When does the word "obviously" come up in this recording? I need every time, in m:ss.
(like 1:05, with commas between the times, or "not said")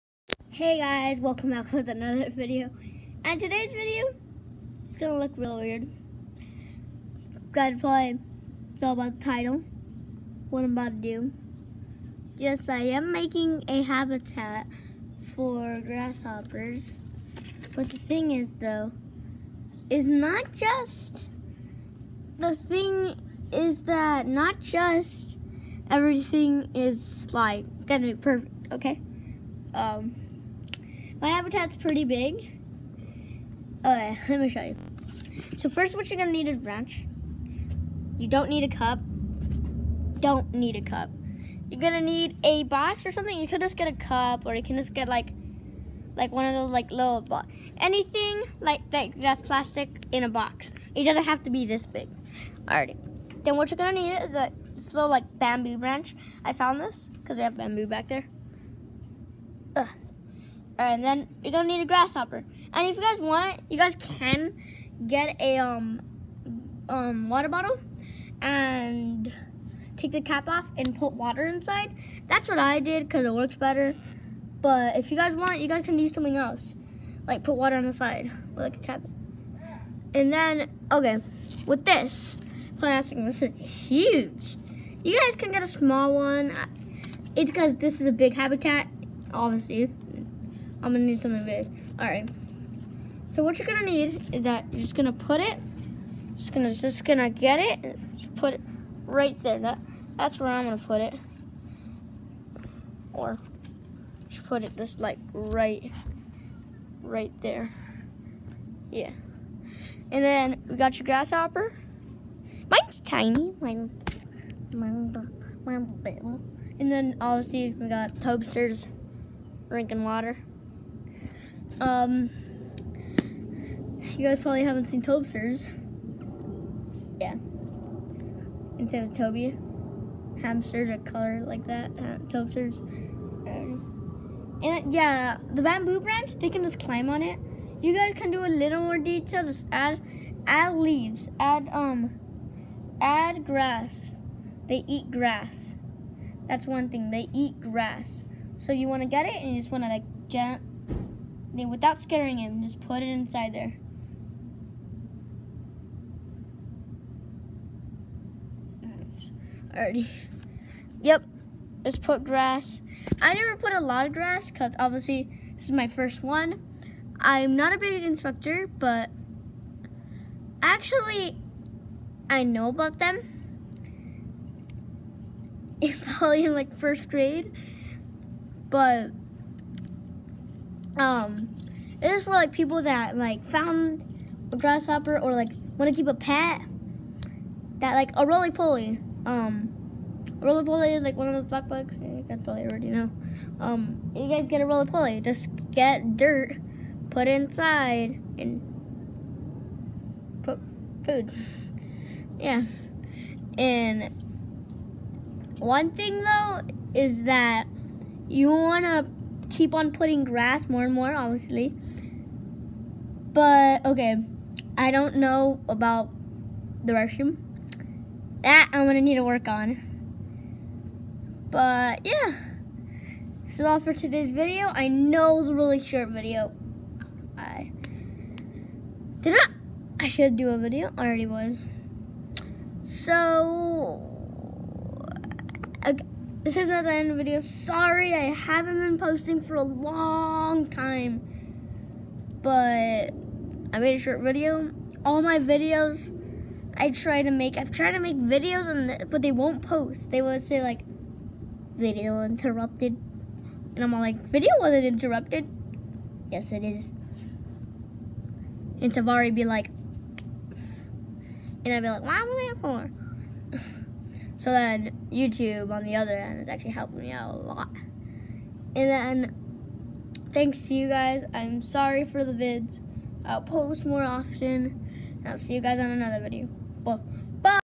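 1:29, 1:57, 2:44, 3:31.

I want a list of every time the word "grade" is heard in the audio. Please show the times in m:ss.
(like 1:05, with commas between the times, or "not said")
2:57.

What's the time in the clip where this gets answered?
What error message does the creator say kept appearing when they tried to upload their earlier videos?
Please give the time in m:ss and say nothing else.
4:11.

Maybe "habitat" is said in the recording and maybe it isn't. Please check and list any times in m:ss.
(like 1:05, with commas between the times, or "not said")
0:13, 0:31, 1:28.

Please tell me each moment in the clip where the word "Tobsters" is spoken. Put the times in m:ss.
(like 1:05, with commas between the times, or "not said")
2:05, 2:12.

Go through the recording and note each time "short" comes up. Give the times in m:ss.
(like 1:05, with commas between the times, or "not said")
3:45, 4:03.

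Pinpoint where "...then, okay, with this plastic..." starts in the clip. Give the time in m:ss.
1:20.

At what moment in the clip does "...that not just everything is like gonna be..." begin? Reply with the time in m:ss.
0:23.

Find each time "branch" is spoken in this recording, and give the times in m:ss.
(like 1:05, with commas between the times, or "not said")
0:36, 0:55, 2:15.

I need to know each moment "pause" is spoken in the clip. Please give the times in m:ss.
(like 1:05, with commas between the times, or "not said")
not said.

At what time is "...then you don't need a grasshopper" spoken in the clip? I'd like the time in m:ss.
1:01.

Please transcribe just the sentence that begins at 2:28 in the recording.
So you want to get it and you just want to like jump they, without scaring him, just put it inside there.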